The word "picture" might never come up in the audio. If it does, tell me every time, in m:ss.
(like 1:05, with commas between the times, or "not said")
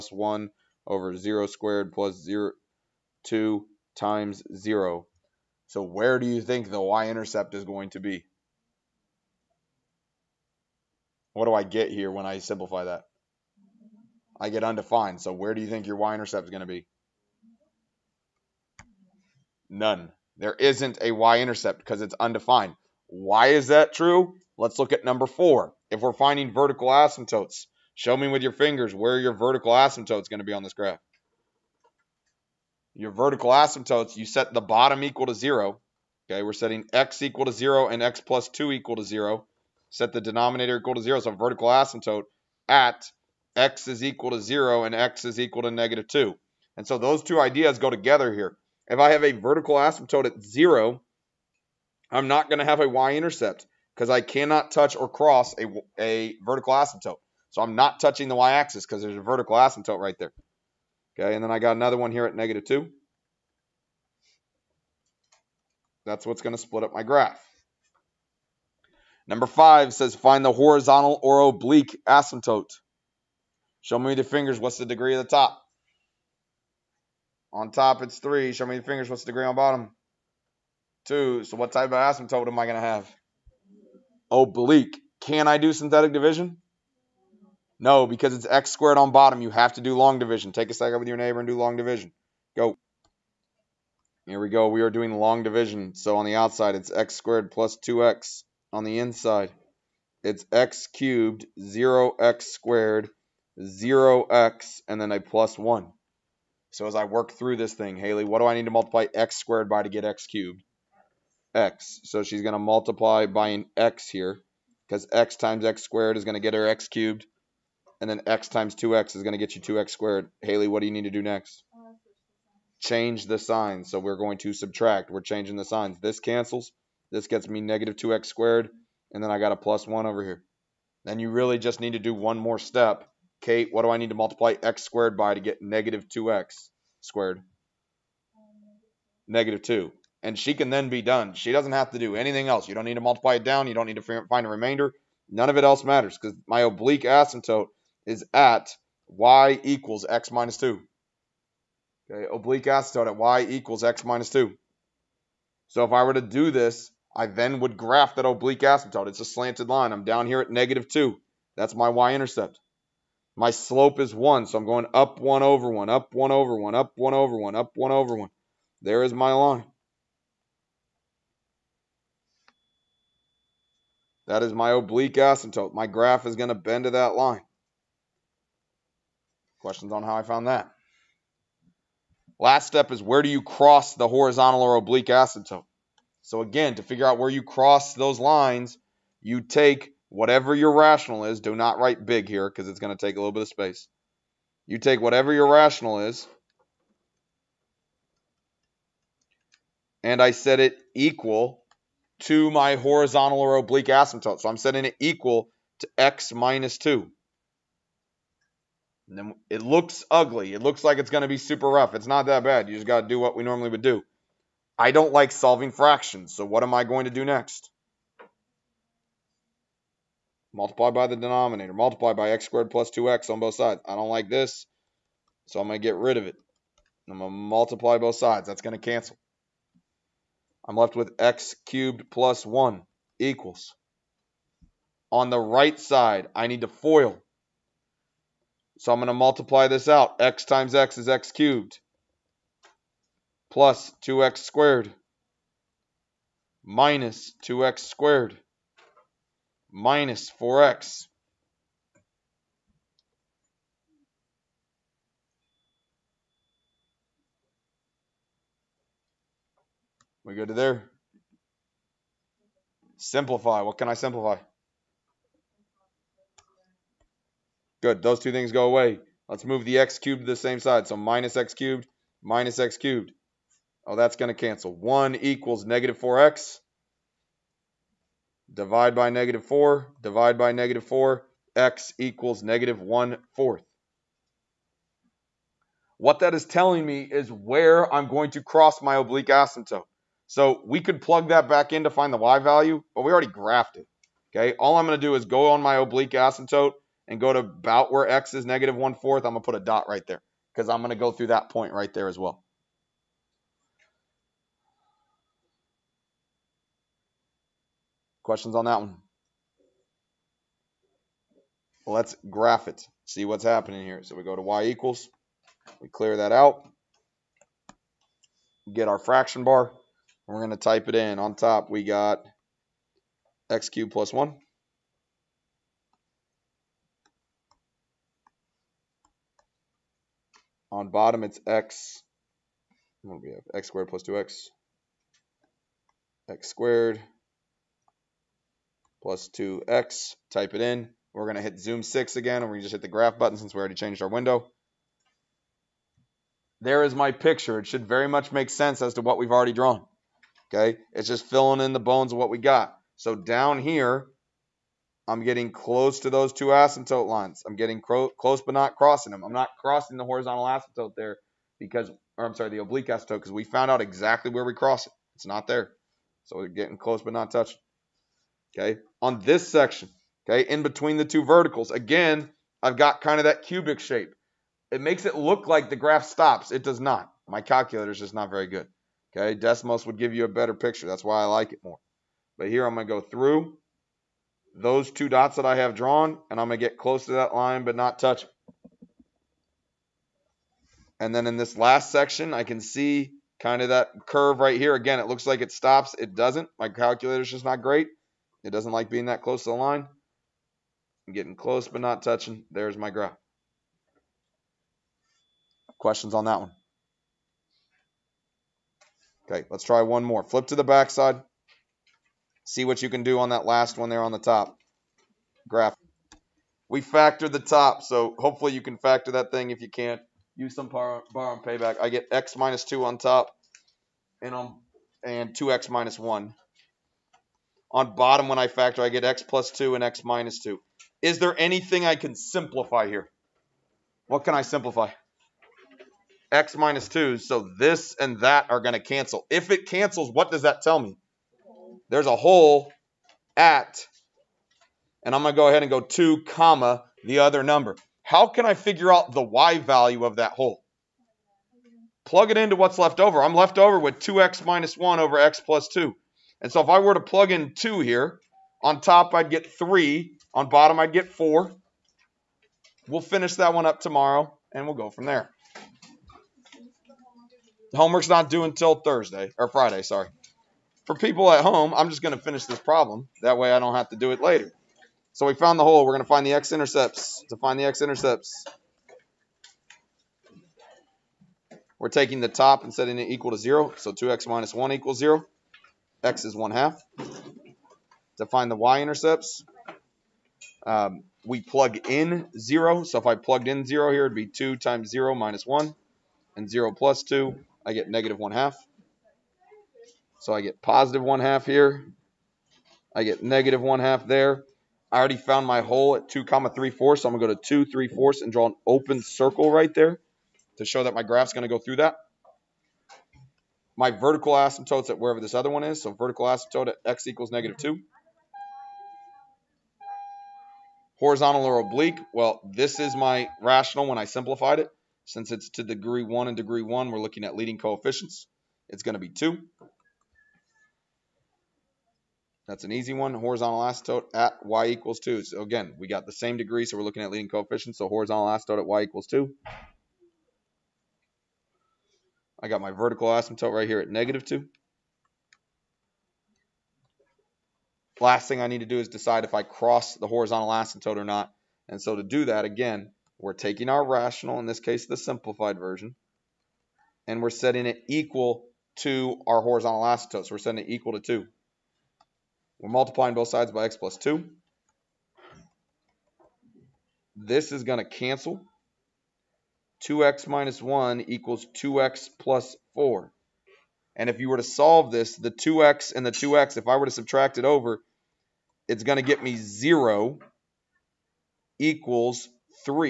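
5:47, 6:20.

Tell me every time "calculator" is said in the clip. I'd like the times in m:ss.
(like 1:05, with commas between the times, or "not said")
6:17, 6:36.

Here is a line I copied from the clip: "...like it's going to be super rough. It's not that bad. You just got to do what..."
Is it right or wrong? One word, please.
right.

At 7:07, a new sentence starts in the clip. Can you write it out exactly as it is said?
On bottom, when I factor, I get x plus 2 and x minus 2.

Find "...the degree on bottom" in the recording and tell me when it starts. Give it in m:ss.
1:19.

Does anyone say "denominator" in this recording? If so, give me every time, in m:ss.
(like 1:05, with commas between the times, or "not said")
0:40, 3:41.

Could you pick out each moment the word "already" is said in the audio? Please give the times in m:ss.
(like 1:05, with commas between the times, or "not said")
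4:53, 5:43, 5:49, 8:24.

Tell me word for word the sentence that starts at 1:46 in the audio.
So as I work through this thing, Haley, what do I need to multiply x squared by to get x cubed?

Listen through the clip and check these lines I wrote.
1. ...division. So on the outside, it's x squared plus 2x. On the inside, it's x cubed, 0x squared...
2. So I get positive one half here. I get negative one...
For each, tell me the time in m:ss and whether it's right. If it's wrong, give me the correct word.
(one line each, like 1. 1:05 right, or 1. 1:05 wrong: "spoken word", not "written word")
1. 1:35 right
2. 8:20 right.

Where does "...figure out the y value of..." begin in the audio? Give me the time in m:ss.
7:28.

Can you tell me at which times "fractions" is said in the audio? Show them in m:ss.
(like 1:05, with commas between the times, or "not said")
3:35, 5:18.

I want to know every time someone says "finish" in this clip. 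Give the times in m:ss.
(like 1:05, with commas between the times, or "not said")
7:43, 7:52.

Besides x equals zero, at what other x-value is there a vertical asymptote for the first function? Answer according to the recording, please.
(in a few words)
-2.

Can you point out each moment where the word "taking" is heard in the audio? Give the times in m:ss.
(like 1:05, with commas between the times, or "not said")
8:01, 9:13.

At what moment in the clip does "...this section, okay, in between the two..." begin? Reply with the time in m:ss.
6:09.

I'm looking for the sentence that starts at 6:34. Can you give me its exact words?
Again, it looks like it stops.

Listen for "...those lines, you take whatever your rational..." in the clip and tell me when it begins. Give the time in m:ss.
3:07.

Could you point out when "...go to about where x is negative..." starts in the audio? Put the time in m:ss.
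4:57.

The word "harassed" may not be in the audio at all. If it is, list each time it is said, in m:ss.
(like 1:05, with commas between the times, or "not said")
not said.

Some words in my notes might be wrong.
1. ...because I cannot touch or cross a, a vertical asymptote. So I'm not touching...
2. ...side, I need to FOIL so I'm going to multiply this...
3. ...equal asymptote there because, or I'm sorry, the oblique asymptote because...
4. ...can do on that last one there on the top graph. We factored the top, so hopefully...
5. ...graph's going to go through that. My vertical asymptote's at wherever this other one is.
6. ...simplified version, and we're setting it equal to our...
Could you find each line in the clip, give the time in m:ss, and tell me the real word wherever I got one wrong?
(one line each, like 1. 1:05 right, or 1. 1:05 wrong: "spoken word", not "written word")
1. 0:53 right
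2. 3:55 right
3. 6:00 wrong: "horizontal", not "equal"
4. 6:52 right
5. 8:31 right
6. 9:14 right.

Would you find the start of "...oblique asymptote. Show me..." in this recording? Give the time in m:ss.
1:11.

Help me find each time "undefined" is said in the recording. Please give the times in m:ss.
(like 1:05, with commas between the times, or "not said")
0:14, 0:22.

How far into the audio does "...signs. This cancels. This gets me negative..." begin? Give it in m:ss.
2:05.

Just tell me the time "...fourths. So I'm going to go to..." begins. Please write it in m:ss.
8:26.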